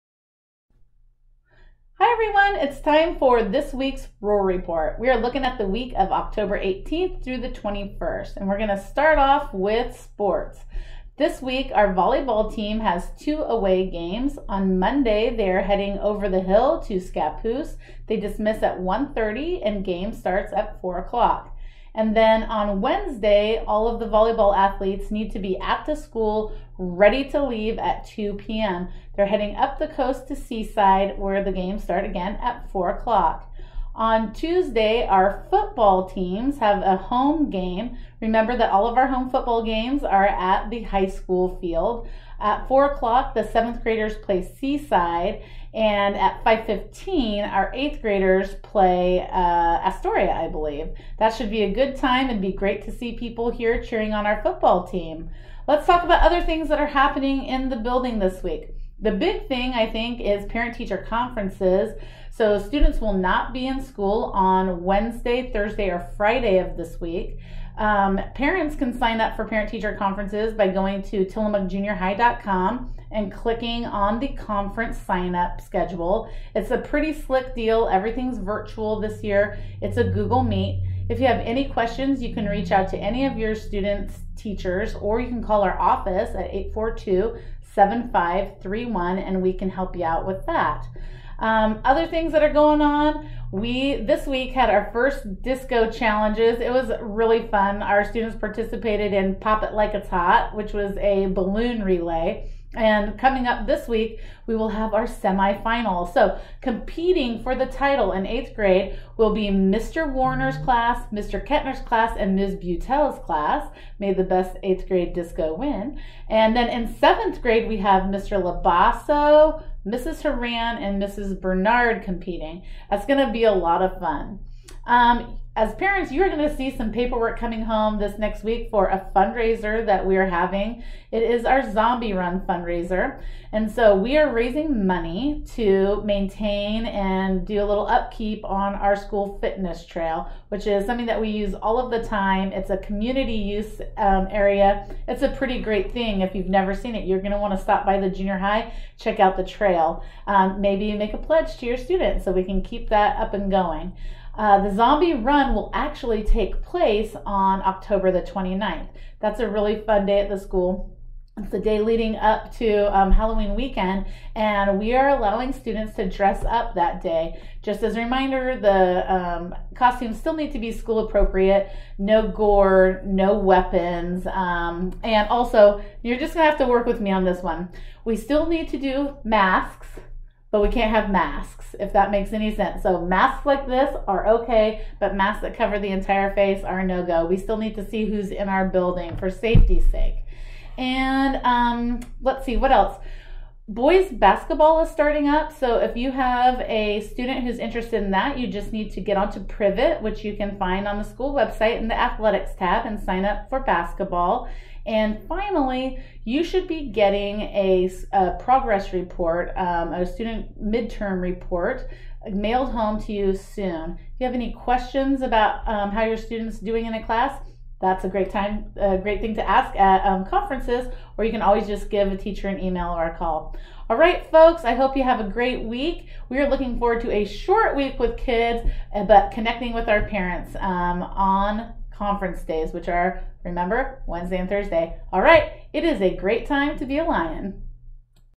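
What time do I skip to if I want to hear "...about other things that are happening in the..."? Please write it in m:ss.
0:56.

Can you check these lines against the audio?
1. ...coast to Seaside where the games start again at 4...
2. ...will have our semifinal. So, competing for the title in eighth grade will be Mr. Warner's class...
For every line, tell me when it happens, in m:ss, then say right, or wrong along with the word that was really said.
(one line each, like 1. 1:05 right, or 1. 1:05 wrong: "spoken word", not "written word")
1. 0:29 right
2. 1:44 right.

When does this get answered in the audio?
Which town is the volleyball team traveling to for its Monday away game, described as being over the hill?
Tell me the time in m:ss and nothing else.
0:16.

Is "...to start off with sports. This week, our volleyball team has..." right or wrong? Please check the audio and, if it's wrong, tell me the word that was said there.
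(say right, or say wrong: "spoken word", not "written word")
right.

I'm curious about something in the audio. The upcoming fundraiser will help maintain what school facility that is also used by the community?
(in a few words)
fitness trail.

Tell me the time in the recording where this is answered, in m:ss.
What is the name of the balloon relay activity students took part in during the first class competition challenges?
1:39.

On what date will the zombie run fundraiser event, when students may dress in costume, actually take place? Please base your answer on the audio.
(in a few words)
October 29.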